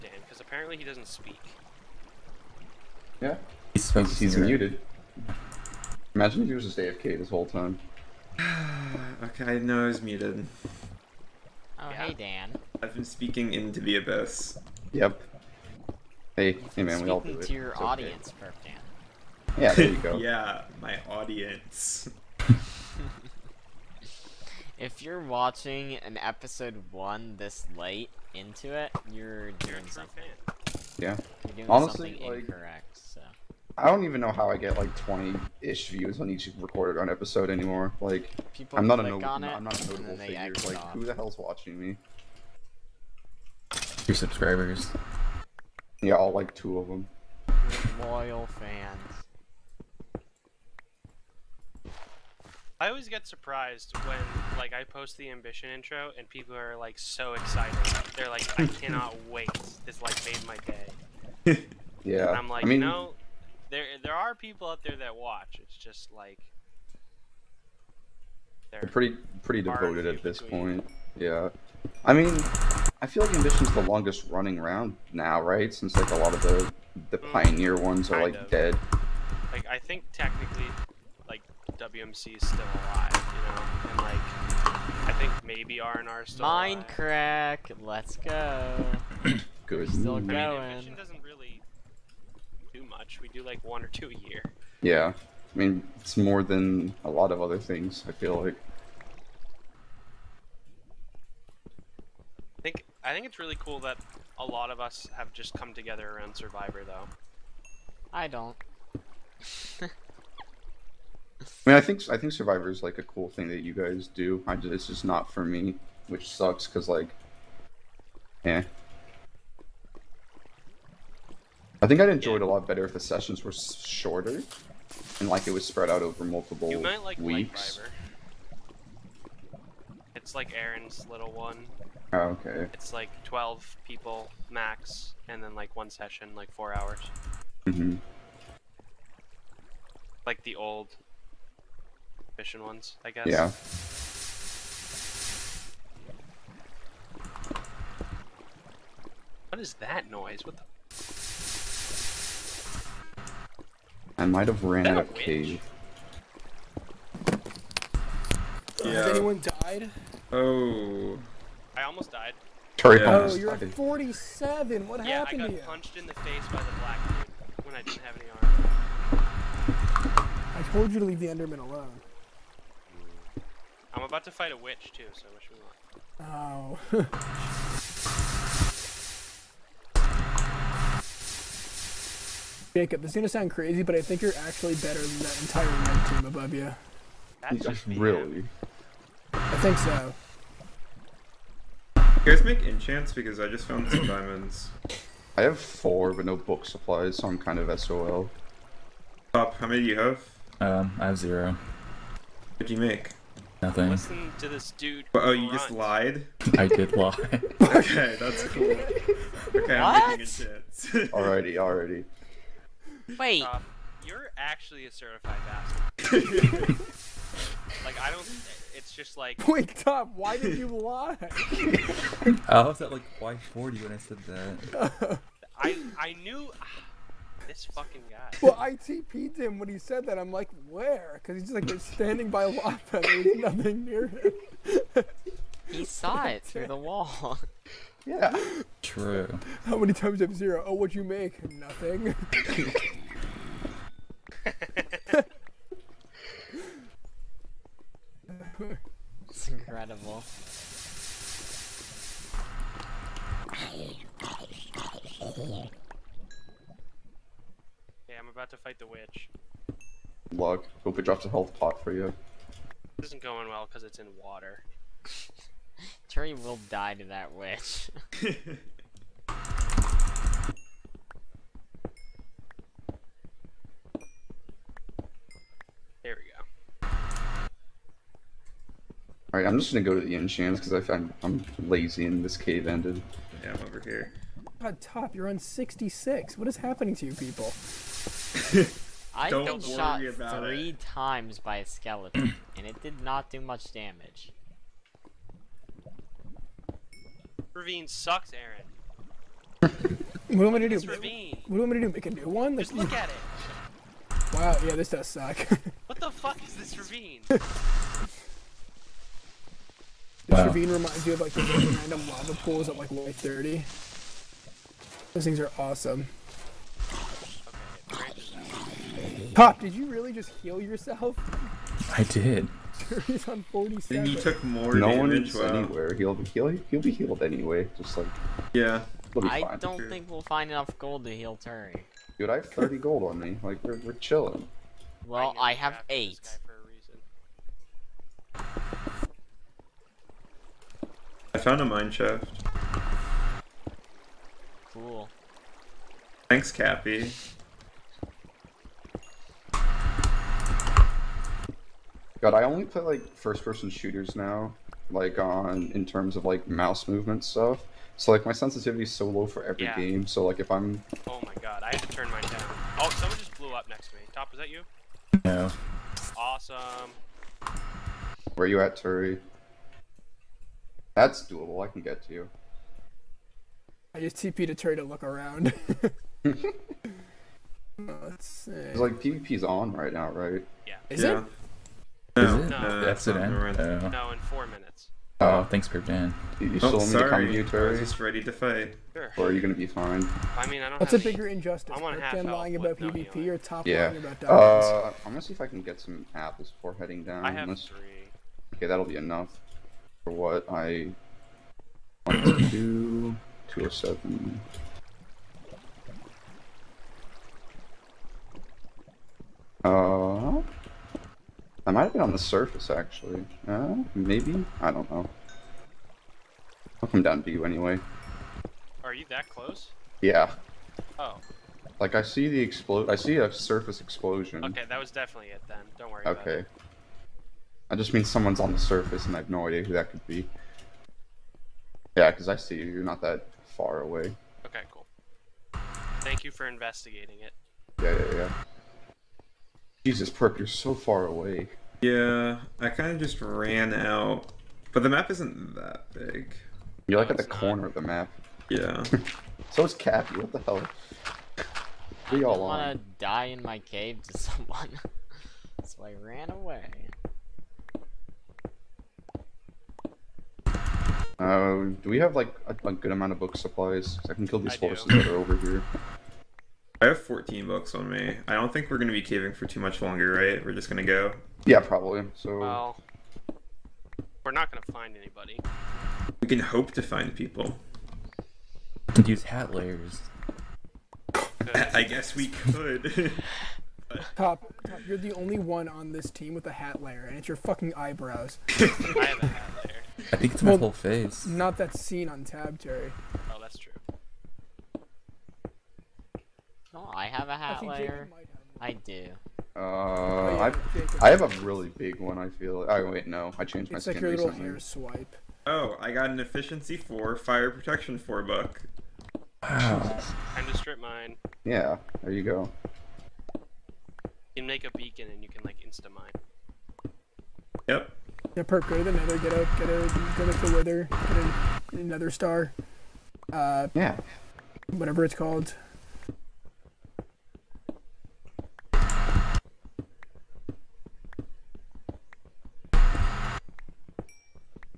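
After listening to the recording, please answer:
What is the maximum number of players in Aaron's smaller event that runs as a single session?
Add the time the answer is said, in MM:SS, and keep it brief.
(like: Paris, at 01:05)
12, at 02:13.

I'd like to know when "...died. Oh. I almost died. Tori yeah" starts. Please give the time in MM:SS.
02:39.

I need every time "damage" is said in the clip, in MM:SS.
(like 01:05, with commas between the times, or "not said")
04:53, 05:24.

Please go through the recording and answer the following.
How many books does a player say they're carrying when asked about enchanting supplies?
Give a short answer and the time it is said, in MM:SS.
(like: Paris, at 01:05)
14, at 07:47.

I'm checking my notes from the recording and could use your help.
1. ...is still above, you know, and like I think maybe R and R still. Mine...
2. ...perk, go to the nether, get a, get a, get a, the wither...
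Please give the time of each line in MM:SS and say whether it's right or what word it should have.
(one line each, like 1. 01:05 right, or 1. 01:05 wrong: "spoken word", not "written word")
1. 01:22 wrong: "alive", not "above"
2. 08:38 right.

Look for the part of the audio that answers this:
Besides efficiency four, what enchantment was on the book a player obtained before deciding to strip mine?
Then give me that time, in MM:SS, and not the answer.
08:27.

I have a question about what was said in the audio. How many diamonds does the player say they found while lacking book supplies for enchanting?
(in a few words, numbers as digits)
4.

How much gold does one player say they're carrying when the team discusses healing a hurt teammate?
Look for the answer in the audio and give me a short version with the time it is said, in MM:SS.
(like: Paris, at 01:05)
30, at 05:32.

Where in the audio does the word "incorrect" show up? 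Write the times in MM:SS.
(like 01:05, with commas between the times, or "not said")
00:32.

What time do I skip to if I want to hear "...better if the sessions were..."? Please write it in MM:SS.
02:02.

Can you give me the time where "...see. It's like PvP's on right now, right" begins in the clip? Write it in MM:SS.
06:18.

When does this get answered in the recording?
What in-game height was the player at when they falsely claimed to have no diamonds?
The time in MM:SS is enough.
03:43.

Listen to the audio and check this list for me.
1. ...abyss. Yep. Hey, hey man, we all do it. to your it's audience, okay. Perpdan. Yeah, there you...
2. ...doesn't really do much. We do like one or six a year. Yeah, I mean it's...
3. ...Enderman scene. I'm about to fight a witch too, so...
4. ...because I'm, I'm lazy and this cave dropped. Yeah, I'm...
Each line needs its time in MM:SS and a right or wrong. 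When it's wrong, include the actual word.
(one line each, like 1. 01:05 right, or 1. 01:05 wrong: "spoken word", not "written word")
1. 00:13 right
2. 01:30 wrong: "two", not "six"
3. 02:51 wrong: "alone", not "scene"
4. 04:40 wrong: "ended", not "dropped".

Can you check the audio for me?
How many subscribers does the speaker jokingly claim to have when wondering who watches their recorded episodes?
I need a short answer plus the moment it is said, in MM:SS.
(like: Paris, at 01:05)
3, at 00:44.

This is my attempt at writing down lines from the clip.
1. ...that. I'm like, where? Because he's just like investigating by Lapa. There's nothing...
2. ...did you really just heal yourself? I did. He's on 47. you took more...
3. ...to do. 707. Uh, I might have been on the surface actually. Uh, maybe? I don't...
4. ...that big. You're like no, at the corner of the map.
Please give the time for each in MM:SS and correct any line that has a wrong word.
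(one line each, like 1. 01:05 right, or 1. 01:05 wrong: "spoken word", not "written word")
1. 03:50 wrong: "standing", not "investigating"
2. 05:19 right
3. 06:42 wrong: "207", not "707"
4. 07:25 right.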